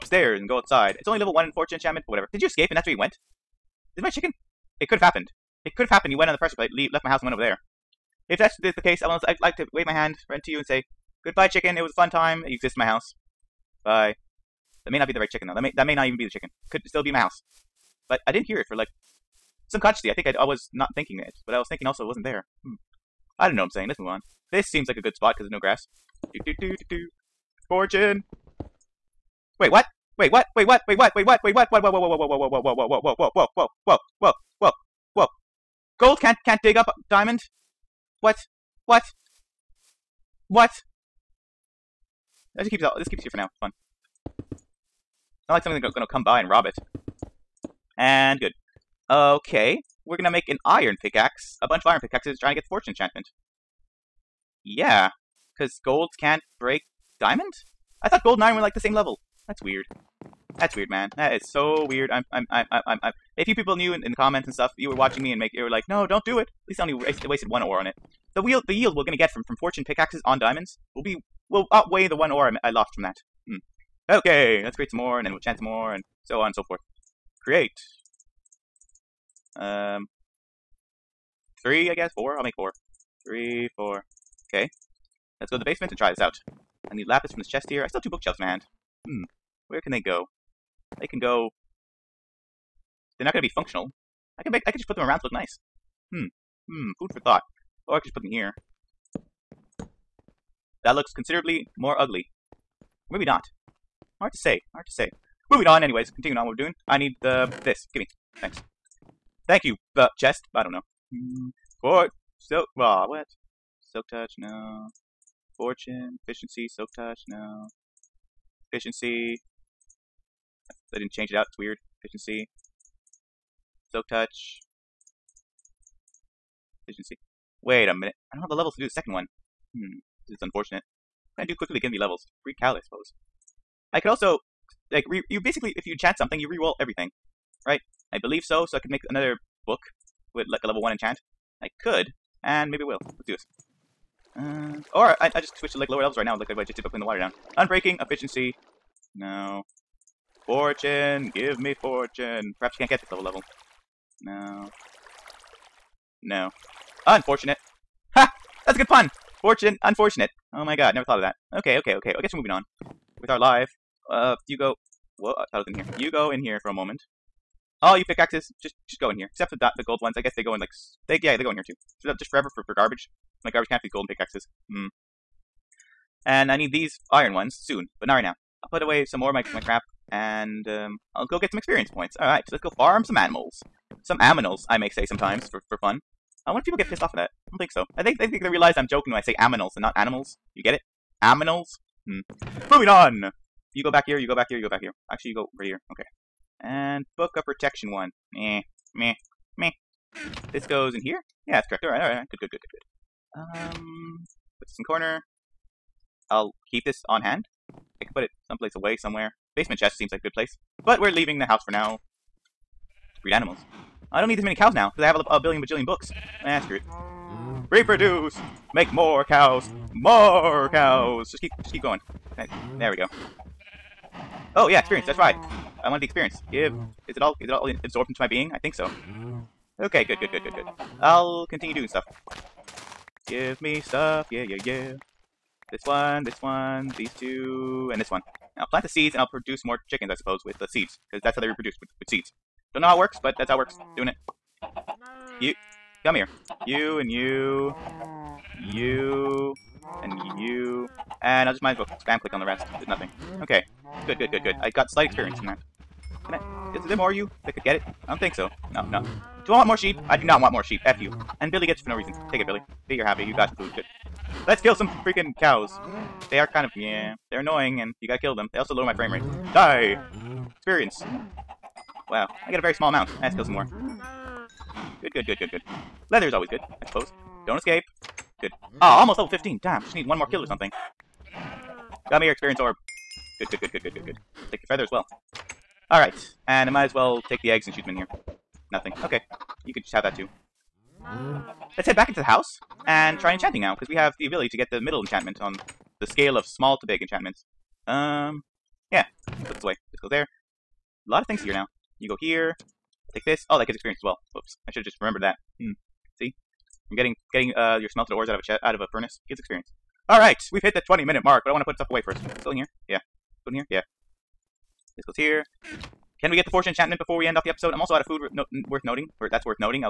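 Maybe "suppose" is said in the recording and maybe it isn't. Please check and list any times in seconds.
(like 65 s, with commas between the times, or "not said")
132 s, 240 s, 276 s.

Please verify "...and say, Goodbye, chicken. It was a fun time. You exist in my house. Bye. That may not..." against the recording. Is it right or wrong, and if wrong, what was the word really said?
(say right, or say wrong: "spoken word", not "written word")
right.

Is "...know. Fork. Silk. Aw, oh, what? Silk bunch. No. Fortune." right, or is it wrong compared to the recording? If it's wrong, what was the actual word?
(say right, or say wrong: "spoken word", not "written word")
wrong: "touch", not "bunch".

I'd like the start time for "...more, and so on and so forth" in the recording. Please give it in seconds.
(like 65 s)
75 s.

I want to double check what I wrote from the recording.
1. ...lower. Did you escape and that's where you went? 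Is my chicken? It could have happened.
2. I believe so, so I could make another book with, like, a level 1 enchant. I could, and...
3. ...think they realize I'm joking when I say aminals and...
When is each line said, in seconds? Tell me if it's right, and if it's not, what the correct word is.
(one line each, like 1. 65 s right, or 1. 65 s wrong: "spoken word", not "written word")
1. 2 s wrong: "whatever", not "lower"
2. 138 s right
3. 188 s right.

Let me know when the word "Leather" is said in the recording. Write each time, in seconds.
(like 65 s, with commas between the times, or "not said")
276 s.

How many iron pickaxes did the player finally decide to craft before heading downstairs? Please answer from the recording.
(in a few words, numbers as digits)
4.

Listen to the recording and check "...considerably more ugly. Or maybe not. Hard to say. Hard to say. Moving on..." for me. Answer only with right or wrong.
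right.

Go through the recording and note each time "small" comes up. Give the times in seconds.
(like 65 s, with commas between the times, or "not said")
272 s, 296 s.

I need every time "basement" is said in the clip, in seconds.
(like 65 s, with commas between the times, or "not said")
85 s, 209 s.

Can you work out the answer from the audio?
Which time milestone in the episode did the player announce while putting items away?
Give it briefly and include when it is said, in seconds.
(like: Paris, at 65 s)
20 minutes, at 310 s.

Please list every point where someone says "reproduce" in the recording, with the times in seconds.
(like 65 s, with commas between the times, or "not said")
217 s, 241 s.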